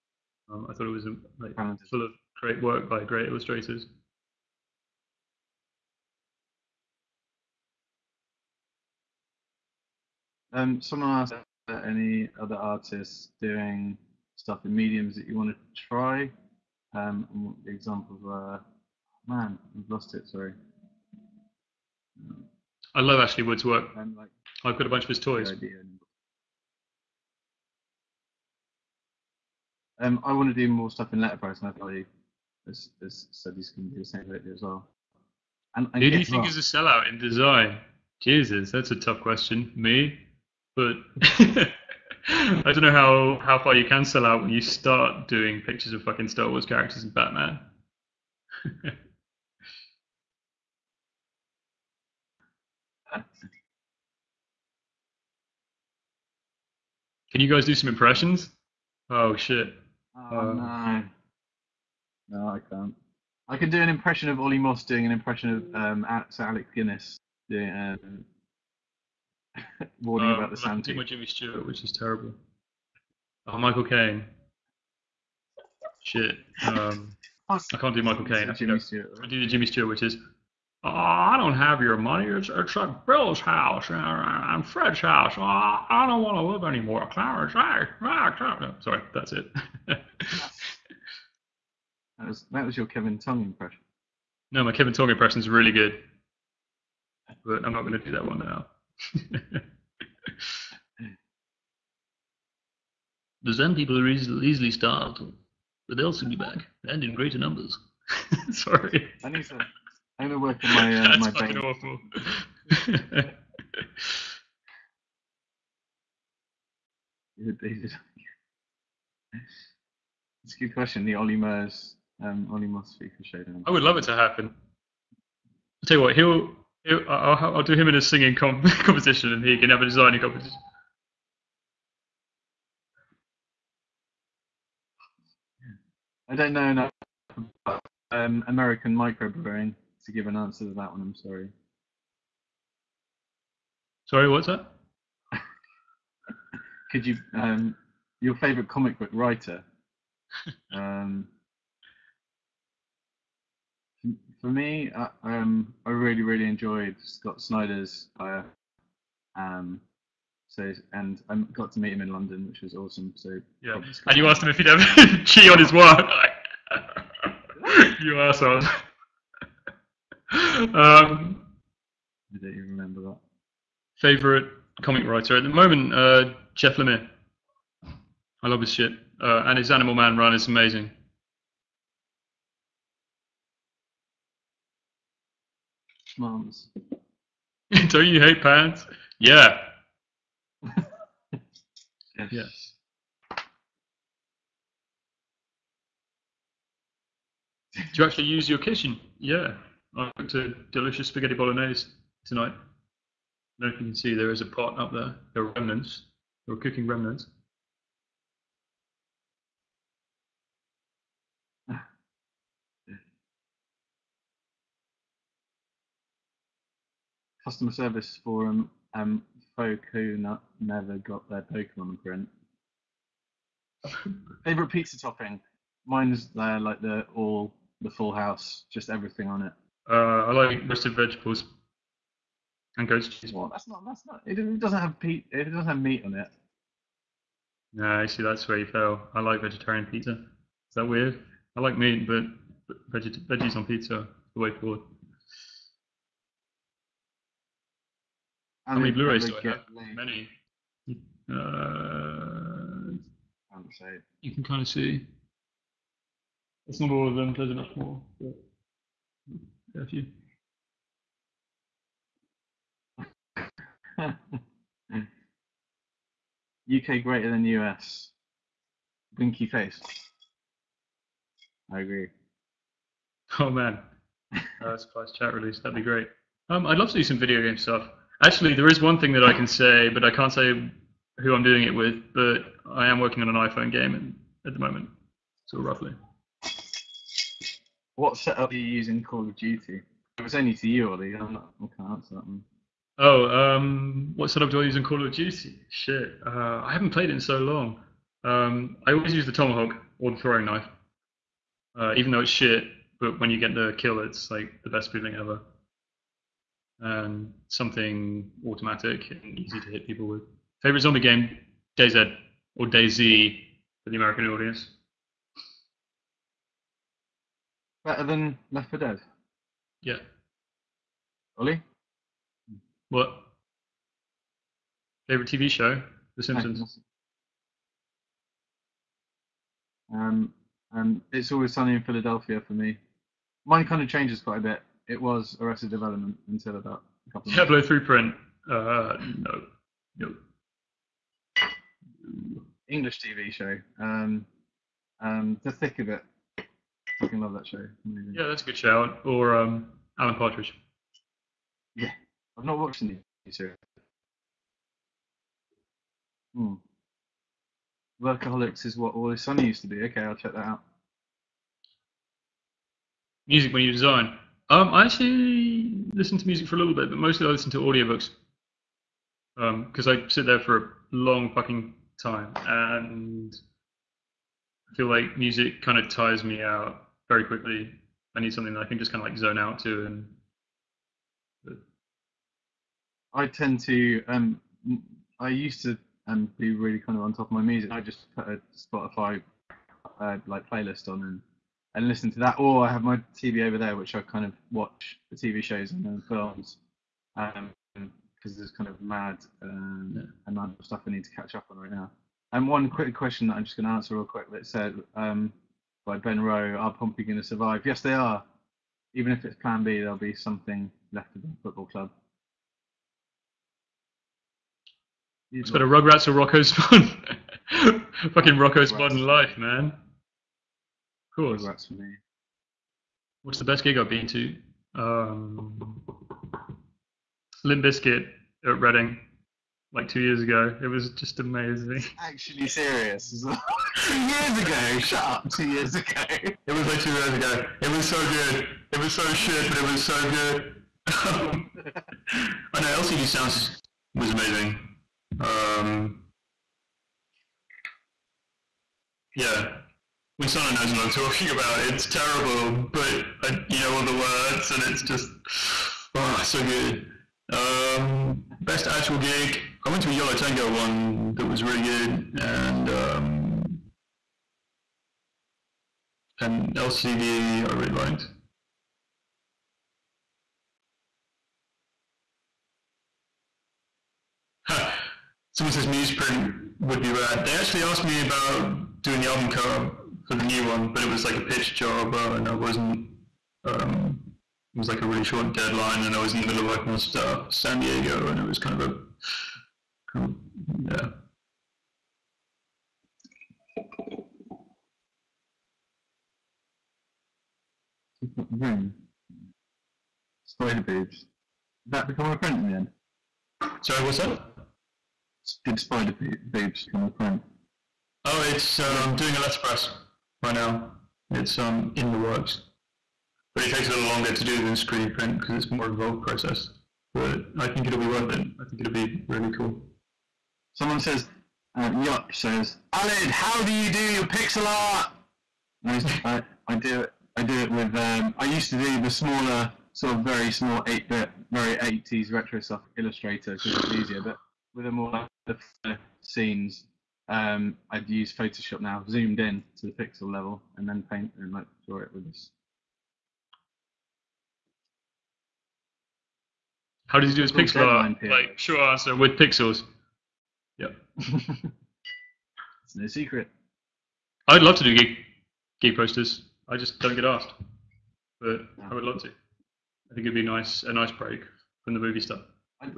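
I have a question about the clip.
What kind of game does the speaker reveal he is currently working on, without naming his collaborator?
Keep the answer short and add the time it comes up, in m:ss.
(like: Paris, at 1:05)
An iPhone game, at 4:43.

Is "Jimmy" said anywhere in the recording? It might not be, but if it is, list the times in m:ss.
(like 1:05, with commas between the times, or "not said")
1:11, 1:19.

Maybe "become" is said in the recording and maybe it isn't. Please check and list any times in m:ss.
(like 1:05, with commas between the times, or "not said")
8:21, 8:26.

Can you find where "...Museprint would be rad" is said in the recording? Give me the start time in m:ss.
7:55.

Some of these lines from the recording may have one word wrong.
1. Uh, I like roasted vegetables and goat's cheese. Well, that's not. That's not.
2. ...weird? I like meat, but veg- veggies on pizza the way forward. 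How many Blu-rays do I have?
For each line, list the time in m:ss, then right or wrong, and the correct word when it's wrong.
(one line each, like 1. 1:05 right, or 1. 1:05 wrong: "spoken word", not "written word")
1. 3:49 right
2. 4:00 right.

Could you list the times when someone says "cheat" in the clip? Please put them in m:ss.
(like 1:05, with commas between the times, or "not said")
2:45.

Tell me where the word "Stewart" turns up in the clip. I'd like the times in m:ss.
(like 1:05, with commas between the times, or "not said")
1:11, 1:19.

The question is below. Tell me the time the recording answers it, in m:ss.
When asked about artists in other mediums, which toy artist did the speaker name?
0:23.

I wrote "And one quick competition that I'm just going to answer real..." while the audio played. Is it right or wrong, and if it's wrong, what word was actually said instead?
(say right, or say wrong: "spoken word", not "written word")
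wrong: "question", not "competition".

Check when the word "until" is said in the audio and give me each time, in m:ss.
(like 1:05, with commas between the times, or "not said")
5:36.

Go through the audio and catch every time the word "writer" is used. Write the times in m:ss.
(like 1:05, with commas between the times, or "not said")
2:29, 2:55.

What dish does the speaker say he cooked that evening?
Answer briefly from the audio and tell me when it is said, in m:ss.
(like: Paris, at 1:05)
Spaghetti bolognese, at 3:21.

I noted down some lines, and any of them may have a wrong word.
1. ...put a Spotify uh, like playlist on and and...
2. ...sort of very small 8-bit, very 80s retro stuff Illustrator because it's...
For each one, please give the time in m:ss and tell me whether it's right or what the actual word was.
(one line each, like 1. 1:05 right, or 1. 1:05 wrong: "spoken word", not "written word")
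1. 6:28 right
2. 8:49 right.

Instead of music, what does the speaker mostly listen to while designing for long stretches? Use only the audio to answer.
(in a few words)
Audiobooks.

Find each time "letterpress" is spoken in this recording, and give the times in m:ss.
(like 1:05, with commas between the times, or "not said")
0:31, 8:29.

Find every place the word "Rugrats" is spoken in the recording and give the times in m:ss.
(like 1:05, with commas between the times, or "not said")
6:55, 7:01.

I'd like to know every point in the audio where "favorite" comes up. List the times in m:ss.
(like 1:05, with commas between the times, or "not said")
2:28, 2:54, 3:44, 5:10, 5:25.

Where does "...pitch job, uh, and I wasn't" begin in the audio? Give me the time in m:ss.
8:01.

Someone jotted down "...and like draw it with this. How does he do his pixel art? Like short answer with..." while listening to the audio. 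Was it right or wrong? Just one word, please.
right.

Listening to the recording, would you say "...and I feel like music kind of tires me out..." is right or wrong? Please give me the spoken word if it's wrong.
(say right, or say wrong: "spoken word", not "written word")
right.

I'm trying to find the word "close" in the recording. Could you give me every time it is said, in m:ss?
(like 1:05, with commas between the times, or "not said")
4:34.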